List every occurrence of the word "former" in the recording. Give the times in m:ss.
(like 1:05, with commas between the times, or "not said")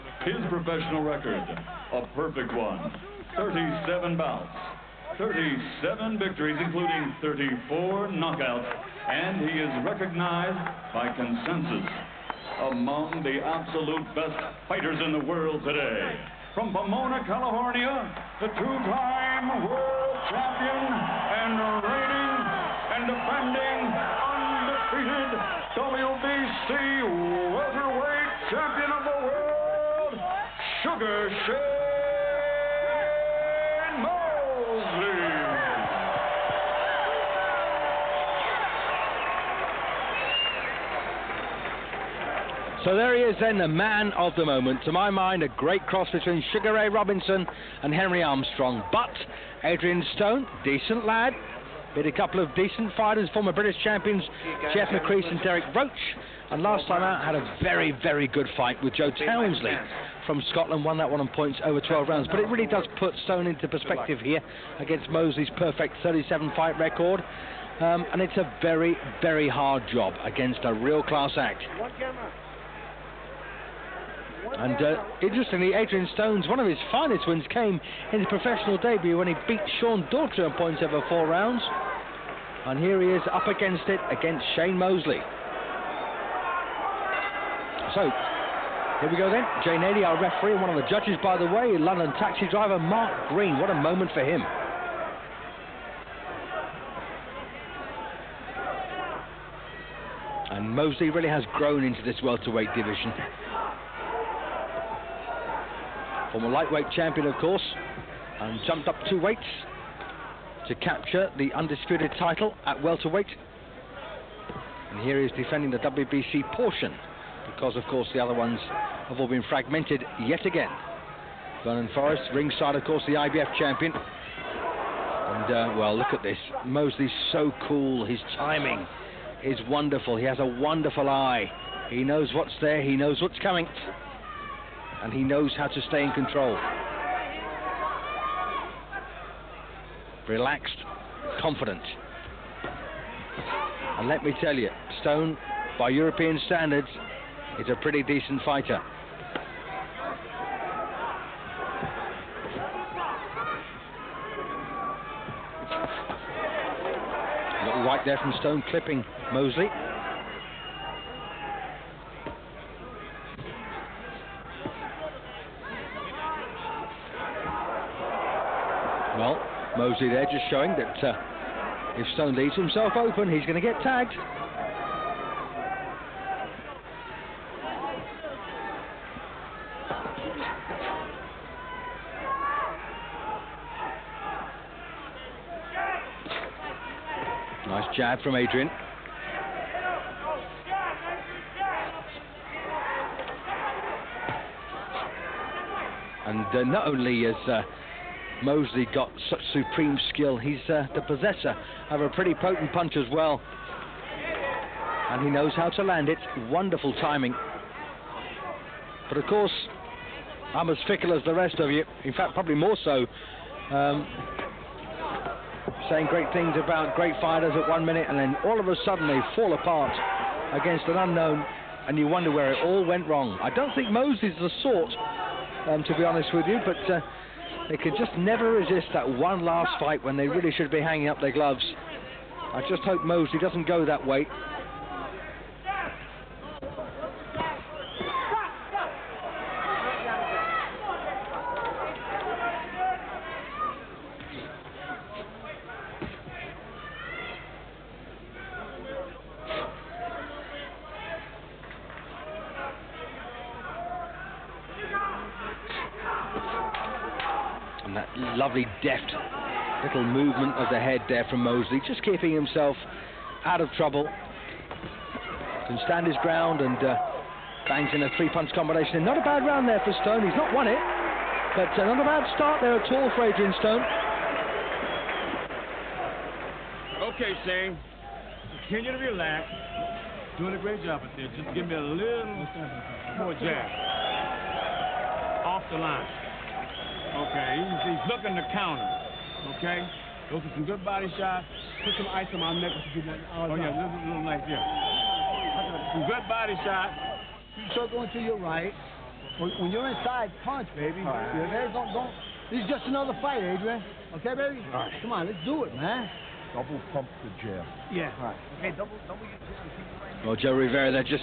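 0:53, 1:46.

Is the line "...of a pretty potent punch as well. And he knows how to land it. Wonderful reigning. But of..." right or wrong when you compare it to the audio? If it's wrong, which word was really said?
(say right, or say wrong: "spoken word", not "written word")
wrong: "timing", not "reigning".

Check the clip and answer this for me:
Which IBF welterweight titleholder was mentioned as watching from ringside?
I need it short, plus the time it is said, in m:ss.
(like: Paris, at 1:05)
Vernon Forrest, at 2:01.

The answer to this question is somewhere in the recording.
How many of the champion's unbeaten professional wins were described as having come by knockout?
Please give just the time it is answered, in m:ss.
0:07.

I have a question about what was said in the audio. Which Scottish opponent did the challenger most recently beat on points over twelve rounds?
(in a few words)
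Joe Townsley.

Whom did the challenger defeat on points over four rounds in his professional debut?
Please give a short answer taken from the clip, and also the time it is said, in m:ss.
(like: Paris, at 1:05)
Sean Daughtry, at 1:19.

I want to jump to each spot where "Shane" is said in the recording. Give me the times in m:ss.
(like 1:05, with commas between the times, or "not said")
0:31, 1:24, 4:37.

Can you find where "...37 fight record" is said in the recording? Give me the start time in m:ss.
1:06.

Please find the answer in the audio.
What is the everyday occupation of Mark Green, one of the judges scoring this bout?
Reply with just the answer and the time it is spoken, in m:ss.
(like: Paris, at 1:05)
London taxi driver, at 1:31.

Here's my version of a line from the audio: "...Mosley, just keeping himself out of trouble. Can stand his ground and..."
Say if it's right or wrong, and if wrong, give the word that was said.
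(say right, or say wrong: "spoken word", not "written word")
right.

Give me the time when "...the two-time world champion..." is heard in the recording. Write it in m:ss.
0:18.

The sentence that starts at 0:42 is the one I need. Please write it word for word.
So there he is, then, the man of the moment.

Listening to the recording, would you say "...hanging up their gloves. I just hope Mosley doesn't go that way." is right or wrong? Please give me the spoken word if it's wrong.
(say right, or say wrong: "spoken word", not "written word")
right.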